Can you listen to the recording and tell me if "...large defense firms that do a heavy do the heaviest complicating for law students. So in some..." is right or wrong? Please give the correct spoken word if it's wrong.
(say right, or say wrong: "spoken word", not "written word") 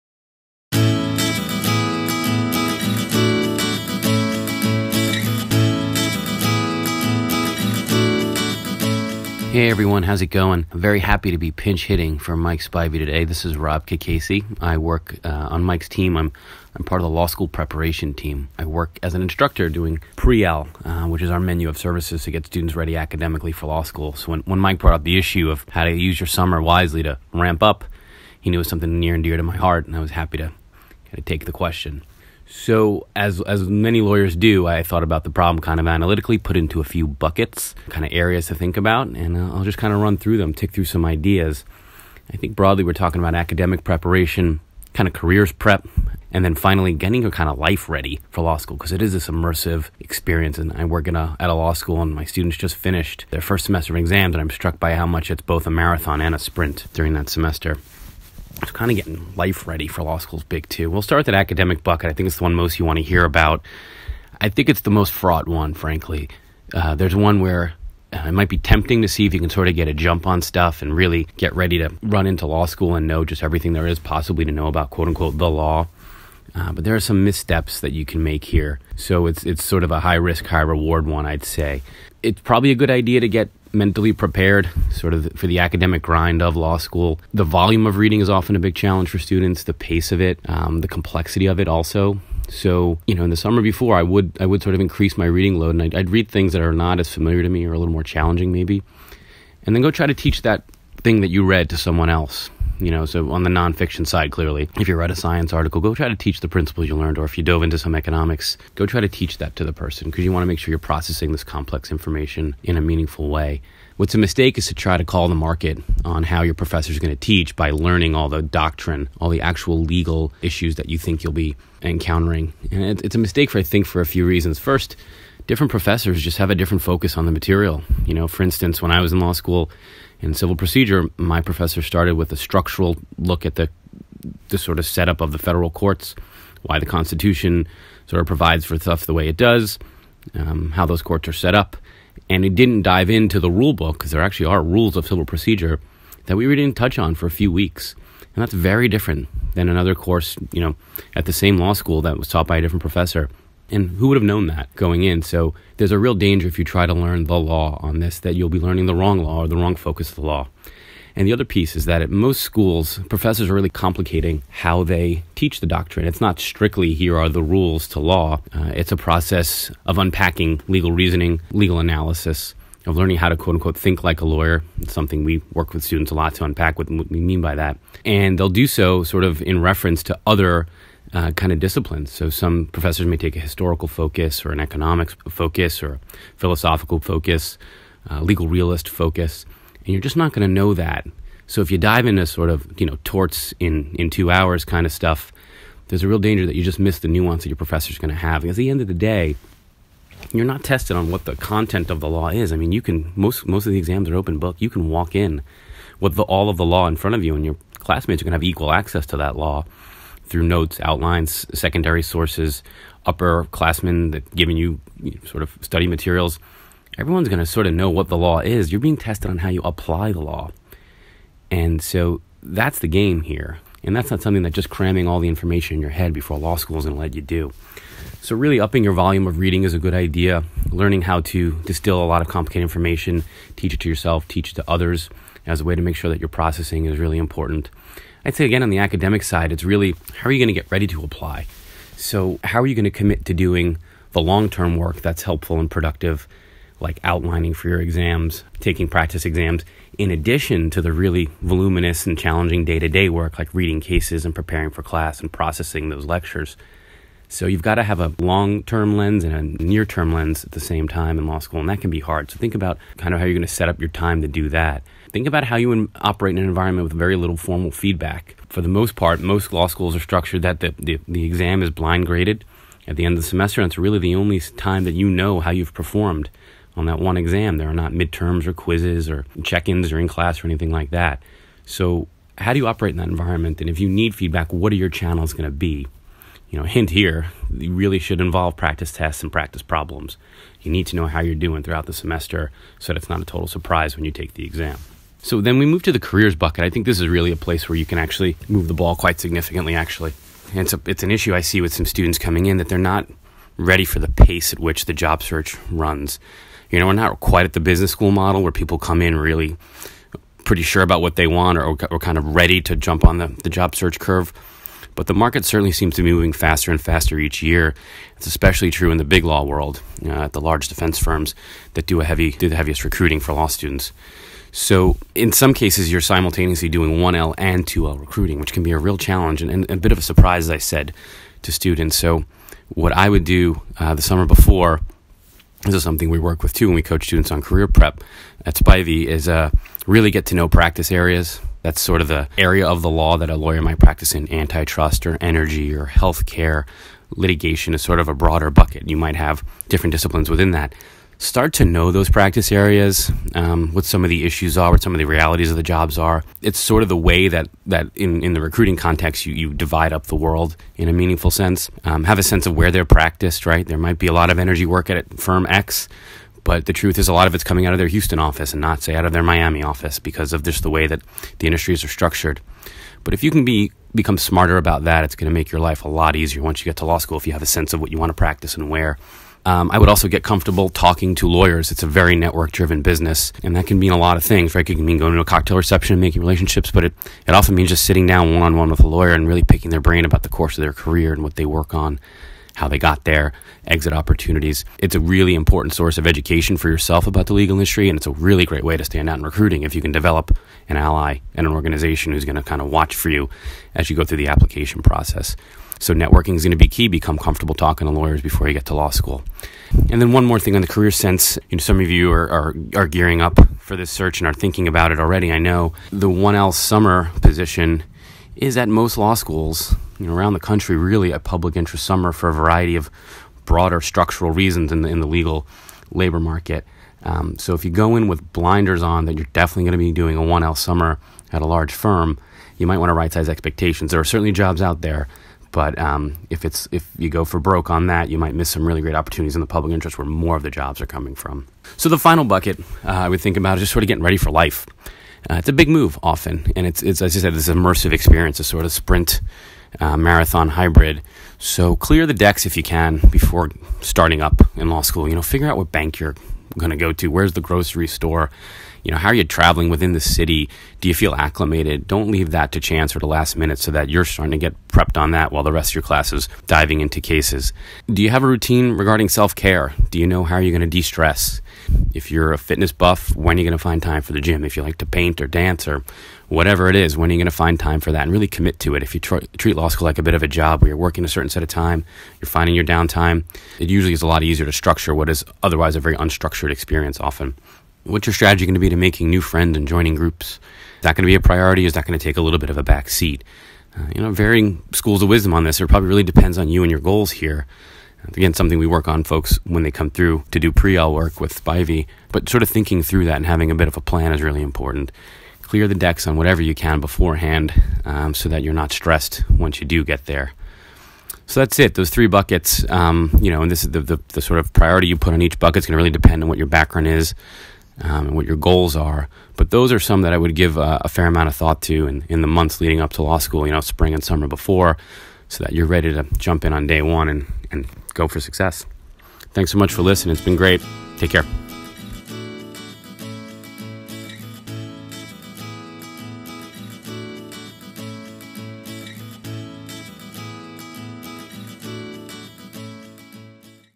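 wrong: "recruiting", not "complicating".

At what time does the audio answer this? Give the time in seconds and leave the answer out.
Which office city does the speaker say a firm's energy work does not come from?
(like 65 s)
369 s.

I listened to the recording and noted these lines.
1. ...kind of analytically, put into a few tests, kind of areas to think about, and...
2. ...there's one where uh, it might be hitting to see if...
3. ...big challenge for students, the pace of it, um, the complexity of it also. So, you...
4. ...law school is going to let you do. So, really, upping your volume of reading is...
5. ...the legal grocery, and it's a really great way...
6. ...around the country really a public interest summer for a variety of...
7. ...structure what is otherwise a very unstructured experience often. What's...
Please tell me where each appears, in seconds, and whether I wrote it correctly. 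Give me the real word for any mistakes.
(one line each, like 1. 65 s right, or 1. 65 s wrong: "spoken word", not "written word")
1. 35 s wrong: "buckets", not "tests"
2. 66 s wrong: "tempting", not "hitting"
3. 88 s right
4. 226 s right
5. 397 s wrong: "industry", not "grocery"
6. 420 s right
7. 484 s right.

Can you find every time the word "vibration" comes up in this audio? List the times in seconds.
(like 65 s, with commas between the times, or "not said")
not said.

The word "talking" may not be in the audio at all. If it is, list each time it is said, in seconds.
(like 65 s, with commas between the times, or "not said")
42 s, 380 s, 407 s.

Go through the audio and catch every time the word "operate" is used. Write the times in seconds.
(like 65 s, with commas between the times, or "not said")
266 s, 282 s.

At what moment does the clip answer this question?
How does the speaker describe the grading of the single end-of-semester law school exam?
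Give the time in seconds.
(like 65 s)
271 s.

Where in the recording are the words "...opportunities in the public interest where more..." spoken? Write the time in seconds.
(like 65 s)
438 s.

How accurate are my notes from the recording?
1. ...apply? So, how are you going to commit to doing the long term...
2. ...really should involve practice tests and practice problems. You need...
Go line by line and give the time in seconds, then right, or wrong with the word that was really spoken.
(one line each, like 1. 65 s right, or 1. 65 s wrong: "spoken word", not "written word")
1. 241 s right
2. 287 s right.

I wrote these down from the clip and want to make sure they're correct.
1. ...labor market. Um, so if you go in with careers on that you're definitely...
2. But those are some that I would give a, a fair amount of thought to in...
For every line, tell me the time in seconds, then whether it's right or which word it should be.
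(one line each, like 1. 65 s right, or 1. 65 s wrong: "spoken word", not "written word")
1. 425 s wrong: "blinders", not "careers"
2. 519 s right.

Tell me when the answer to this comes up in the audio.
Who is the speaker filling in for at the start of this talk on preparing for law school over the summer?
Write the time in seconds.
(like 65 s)
12 s.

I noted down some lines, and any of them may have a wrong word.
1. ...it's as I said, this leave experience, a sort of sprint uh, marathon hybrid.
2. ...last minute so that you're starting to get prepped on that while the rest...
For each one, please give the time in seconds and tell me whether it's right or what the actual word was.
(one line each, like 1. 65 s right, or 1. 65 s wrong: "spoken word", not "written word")
1. 446 s wrong: "immersive", not "leave"
2. 463 s right.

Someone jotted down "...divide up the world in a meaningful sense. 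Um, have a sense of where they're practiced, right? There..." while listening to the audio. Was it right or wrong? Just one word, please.
right.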